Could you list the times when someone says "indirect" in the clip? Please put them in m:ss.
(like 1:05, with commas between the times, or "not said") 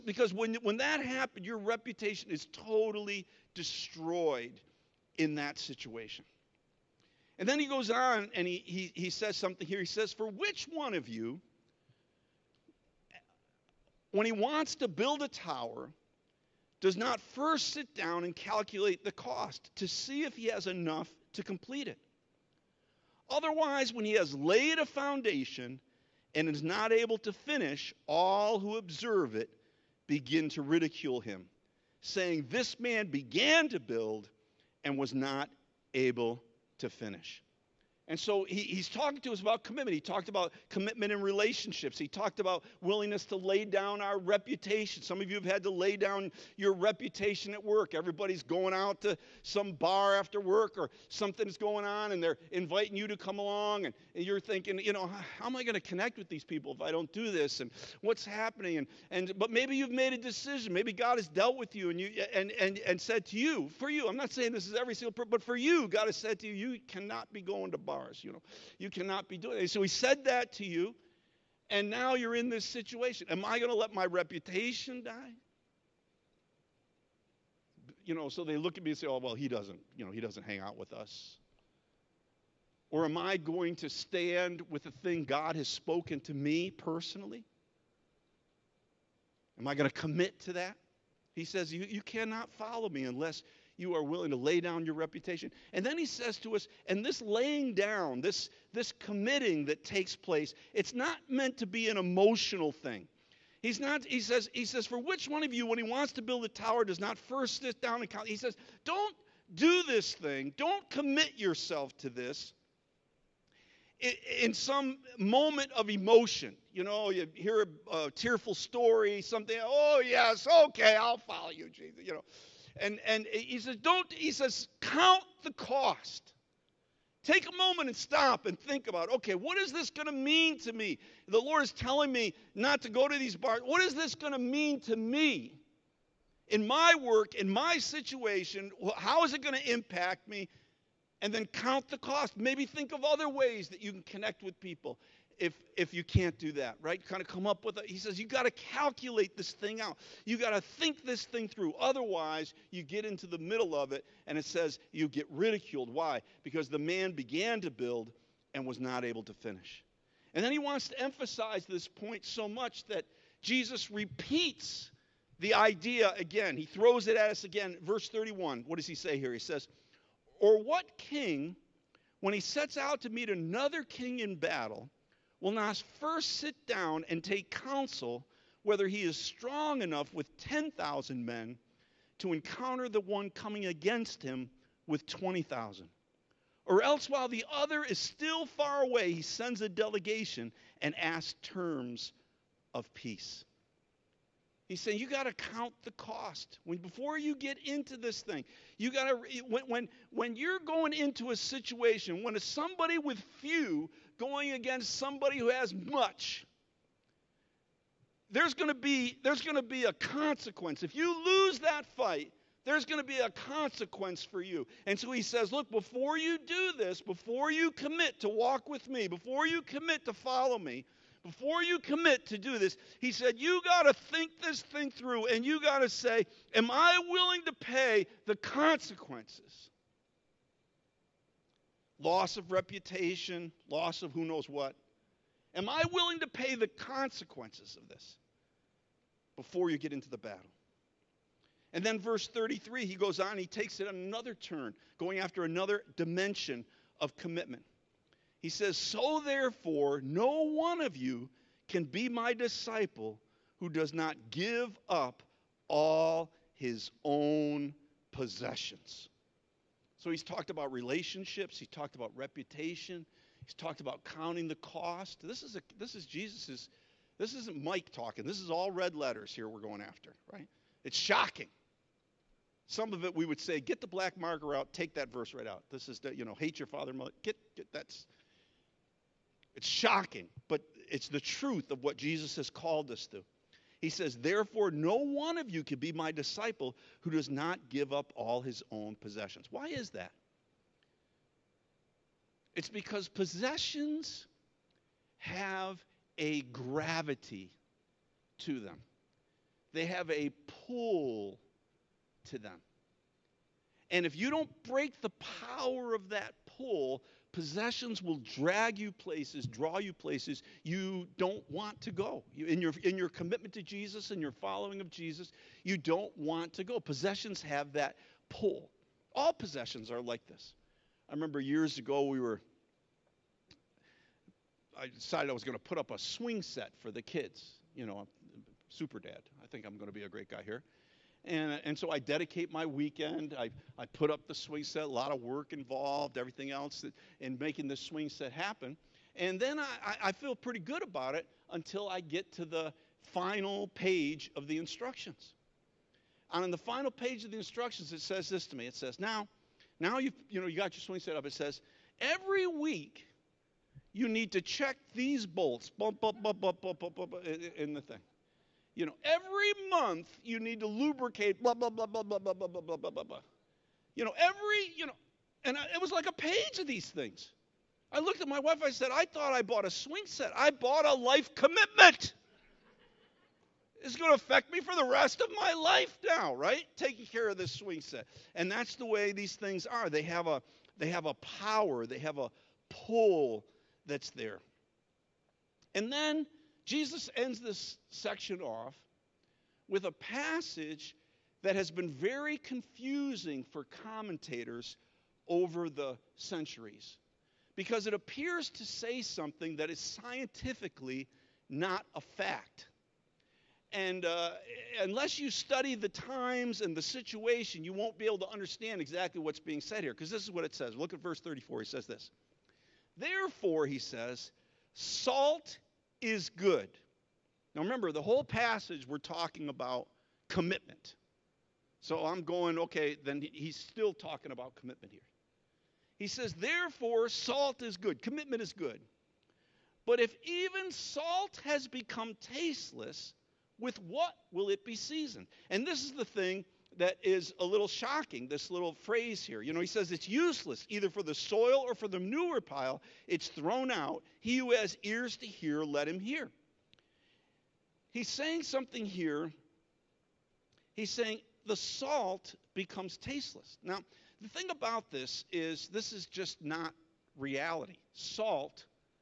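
not said.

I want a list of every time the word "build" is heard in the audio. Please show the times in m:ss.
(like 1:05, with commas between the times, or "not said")
0:14, 0:33, 1:46, 2:37.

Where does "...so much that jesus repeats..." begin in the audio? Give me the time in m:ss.
2:42.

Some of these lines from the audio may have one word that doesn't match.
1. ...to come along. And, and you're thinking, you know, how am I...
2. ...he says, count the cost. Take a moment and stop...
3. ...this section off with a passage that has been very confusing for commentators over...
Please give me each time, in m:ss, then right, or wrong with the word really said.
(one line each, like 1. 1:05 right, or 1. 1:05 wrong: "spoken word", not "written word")
1. 0:53 right
2. 2:04 right
3. 6:27 right.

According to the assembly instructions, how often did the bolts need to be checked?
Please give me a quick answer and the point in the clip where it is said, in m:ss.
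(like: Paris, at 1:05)
every week, at 5:52.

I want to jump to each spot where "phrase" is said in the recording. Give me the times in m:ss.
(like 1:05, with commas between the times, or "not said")
7:18.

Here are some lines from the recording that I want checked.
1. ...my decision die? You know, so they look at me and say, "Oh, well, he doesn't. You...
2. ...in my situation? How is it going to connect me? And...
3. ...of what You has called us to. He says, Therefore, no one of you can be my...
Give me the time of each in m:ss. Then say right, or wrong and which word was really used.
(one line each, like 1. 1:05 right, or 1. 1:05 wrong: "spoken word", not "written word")
1. 1:13 wrong: "reputation", not "decision"
2. 2:17 wrong: "impact", not "connect"
3. 4:41 wrong: "Jesus", not "You".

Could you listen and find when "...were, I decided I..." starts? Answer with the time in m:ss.
5:22.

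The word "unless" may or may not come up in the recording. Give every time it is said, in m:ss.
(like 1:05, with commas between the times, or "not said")
1:33, 6:44.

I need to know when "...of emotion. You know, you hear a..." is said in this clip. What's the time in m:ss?
1:55.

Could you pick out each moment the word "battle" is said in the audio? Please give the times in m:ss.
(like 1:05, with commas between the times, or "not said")
2:54, 4:00.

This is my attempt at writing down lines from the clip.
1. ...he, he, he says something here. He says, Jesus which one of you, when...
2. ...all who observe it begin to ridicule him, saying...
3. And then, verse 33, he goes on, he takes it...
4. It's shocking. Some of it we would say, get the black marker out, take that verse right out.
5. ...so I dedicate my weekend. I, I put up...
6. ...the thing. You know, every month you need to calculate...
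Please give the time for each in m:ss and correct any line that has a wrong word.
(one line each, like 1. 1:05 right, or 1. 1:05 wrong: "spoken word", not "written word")
1. 0:08 wrong: "For", not "Jesus"
2. 0:28 right
3. 4:01 right
4. 4:30 right
5. 5:31 right
6. 5:57 wrong: "lubricate", not "calculate".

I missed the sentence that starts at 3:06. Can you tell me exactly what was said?
Or else, while the other is still far away, he sends a delegation and asks terms of peace.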